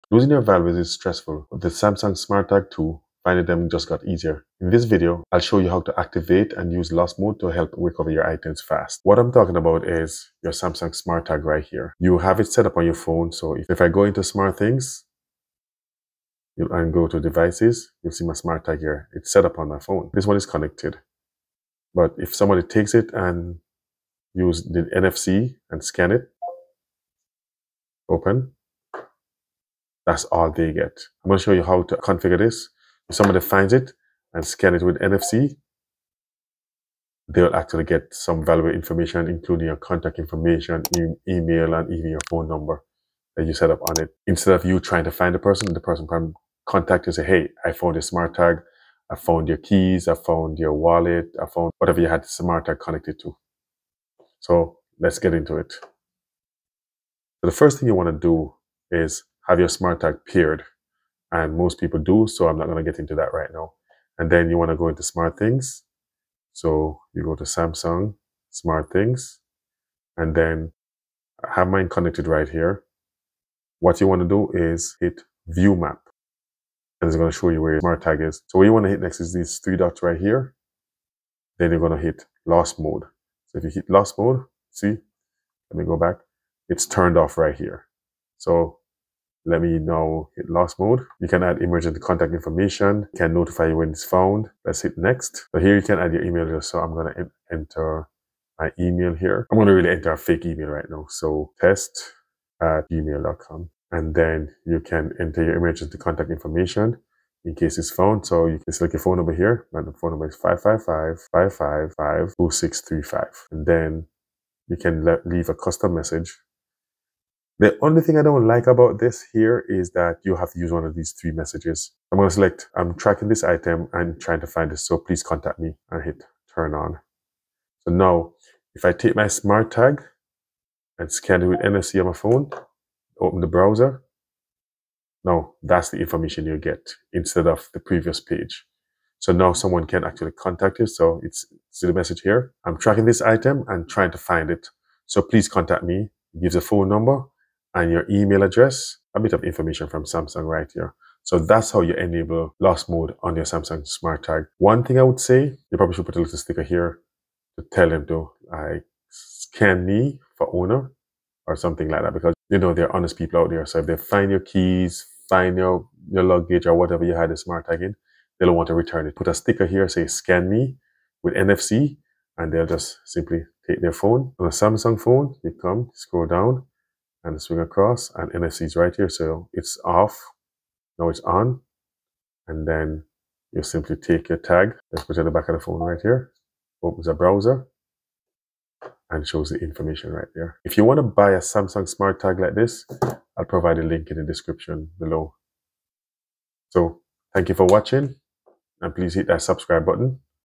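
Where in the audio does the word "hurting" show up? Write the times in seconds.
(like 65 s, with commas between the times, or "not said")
not said.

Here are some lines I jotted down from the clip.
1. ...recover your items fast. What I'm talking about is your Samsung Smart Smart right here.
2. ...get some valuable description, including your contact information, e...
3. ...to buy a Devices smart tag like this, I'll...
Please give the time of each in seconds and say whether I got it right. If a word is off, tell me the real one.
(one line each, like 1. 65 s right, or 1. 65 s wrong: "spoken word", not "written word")
1. 7 s wrong: "Tag", not "Smart"
2. 37 s wrong: "information", not "description"
3. 190 s wrong: "Samsung", not "Devices".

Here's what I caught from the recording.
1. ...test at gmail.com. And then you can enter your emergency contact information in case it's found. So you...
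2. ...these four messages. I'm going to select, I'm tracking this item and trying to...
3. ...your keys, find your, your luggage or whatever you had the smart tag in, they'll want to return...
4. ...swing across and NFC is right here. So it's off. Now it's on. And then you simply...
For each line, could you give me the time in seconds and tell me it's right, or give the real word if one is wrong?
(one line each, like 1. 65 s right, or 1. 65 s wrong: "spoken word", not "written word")
1. 101 s right
2. 120 s wrong: "three", not "four"
3. 164 s right
4. 177 s right.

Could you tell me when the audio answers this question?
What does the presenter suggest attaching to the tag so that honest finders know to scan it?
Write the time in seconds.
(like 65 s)
156 s.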